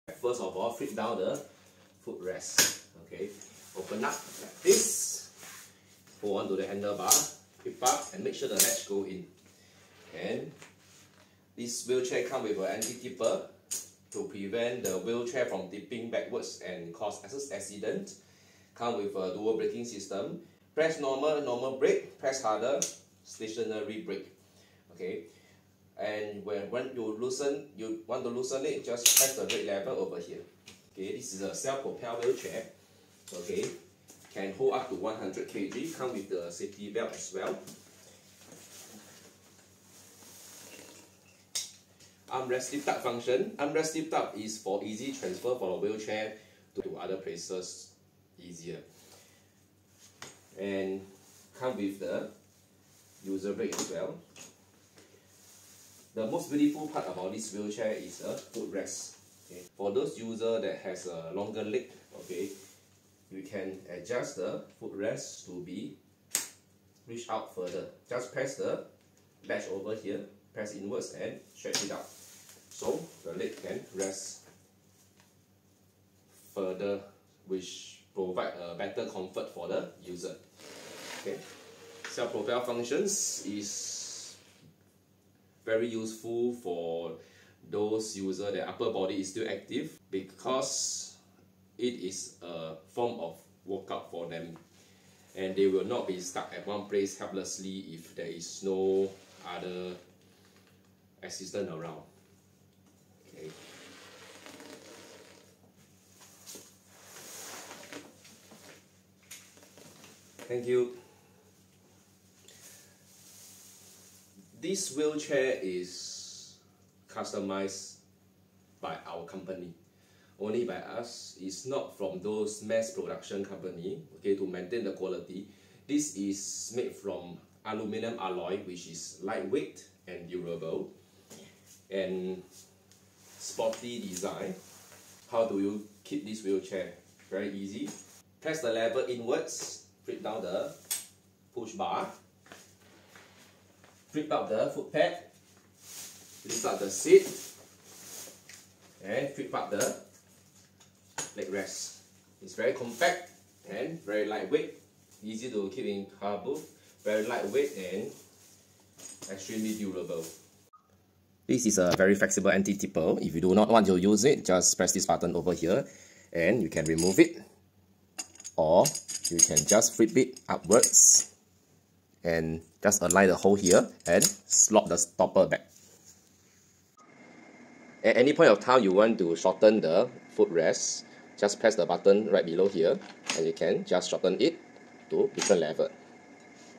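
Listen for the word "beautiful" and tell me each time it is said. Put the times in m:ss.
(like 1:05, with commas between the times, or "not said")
0:56.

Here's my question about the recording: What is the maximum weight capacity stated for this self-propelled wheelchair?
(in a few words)
100 kg.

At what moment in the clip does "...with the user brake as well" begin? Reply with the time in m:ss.
0:51.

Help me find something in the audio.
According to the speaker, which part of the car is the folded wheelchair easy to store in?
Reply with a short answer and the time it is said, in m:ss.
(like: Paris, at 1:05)
Car boot, at 2:36.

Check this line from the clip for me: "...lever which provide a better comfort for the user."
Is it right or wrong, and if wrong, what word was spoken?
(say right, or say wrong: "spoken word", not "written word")
wrong: "further", not "lever".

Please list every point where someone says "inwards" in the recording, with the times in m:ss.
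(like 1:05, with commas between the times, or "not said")
1:10, 2:19.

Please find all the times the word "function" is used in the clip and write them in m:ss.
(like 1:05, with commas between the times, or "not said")
0:43, 1:22.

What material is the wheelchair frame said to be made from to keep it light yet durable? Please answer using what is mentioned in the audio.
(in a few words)
Aluminum alloy.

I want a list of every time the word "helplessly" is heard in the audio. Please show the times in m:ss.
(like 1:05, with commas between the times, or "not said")
1:37.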